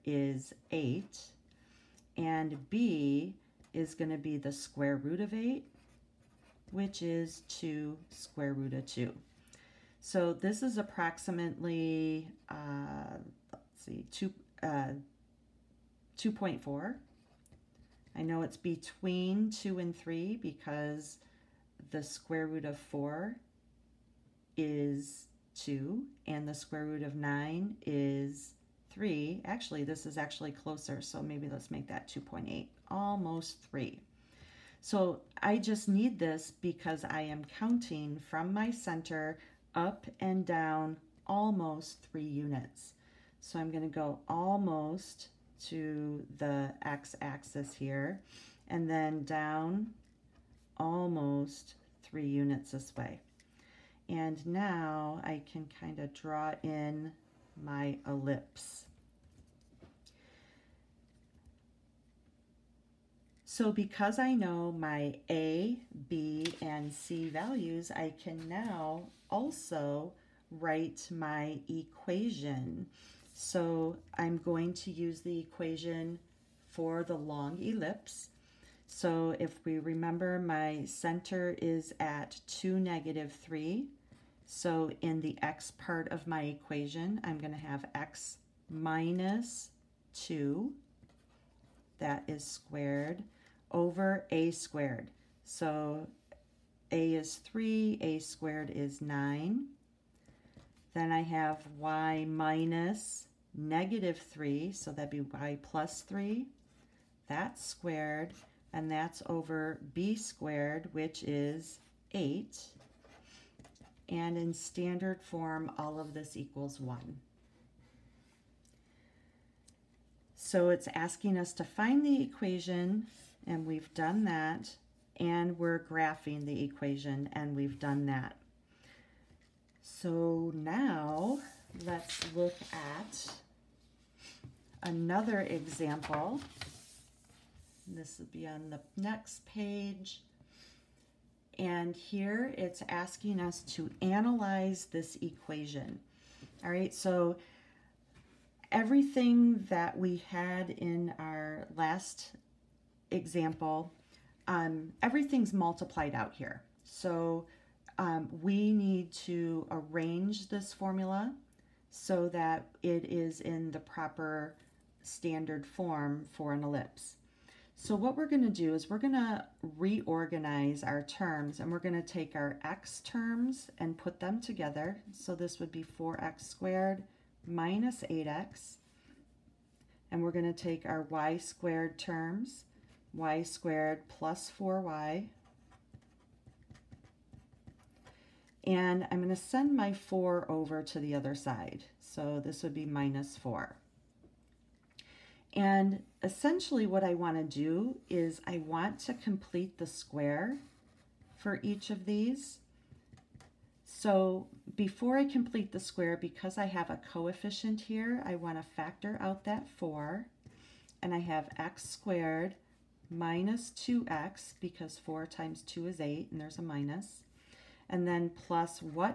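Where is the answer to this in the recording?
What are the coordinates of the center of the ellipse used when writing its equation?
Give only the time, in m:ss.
1:22.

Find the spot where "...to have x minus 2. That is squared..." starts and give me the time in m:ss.
1:27.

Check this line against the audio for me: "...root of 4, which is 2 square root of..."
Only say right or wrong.
wrong.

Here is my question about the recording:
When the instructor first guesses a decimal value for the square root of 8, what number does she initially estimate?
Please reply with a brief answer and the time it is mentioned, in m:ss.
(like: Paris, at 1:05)
2.4, at 0:16.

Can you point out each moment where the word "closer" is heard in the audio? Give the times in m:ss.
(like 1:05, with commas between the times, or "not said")
0:30.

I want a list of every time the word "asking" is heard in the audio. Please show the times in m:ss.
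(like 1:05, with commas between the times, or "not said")
2:00, 2:22.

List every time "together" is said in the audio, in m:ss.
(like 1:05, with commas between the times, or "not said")
2:54.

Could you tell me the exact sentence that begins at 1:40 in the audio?
Then I have y minus negative 3, so that'd be y plus 3.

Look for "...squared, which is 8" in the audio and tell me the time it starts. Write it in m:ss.
1:50.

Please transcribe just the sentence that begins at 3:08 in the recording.
And I'm going to send my 4 over to the other side.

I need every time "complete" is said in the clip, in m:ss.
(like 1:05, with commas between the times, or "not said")
3:19, 3:25.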